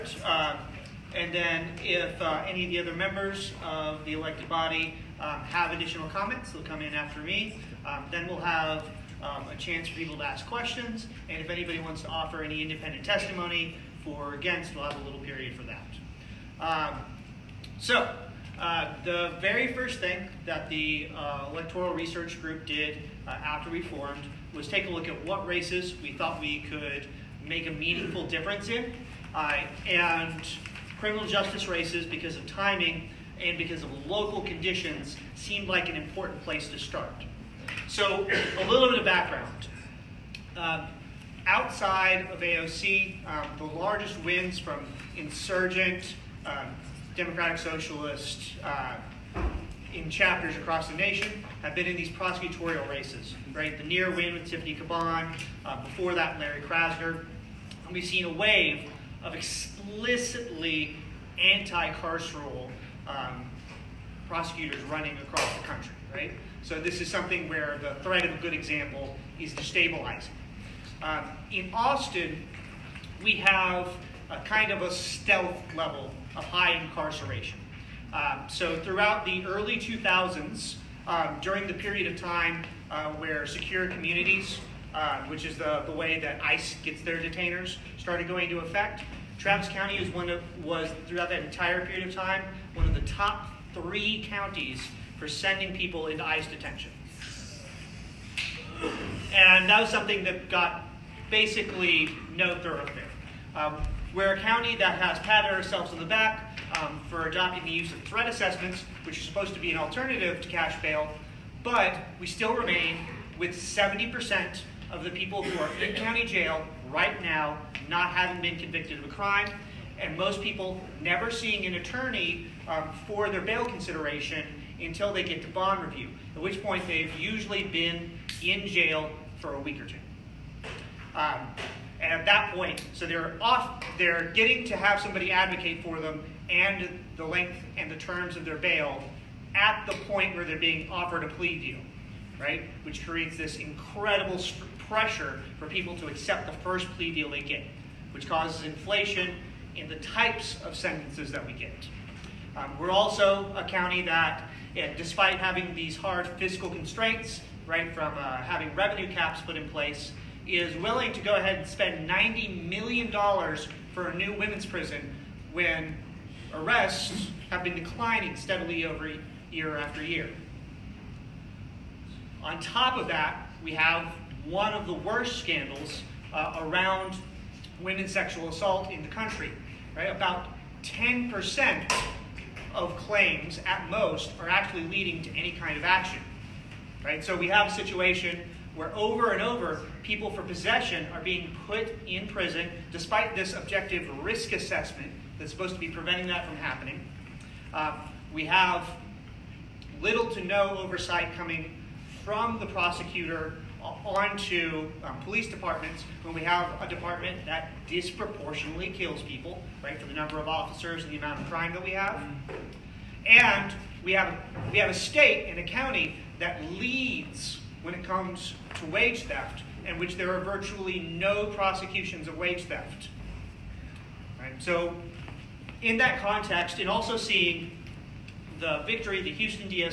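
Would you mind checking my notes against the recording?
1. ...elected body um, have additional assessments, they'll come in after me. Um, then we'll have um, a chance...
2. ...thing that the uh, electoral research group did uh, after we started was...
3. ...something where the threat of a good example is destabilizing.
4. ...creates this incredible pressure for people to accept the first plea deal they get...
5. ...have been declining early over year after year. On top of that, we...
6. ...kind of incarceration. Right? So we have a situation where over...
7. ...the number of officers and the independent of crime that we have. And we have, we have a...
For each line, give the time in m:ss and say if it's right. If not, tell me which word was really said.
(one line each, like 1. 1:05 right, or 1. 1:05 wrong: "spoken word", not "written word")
1. 0:04 wrong: "comments", not "assessments"
2. 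0:19 wrong: "formed", not "started"
3. 1:07 right
4. 2:23 right
5. 2:47 wrong: "steadily", not "early"
6. 3:05 wrong: "action", not "incarceration"
7. 3:30 wrong: "amount", not "independent".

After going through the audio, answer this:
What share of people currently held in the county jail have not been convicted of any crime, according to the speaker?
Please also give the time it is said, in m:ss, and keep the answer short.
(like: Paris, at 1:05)
70%, at 1:53.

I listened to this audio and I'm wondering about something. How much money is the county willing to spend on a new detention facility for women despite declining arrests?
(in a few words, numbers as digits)
$90 million.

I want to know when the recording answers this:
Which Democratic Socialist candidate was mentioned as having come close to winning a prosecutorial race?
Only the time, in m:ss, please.
0:54.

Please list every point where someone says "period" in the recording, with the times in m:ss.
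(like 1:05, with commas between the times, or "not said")
0:15, 1:21, 1:31.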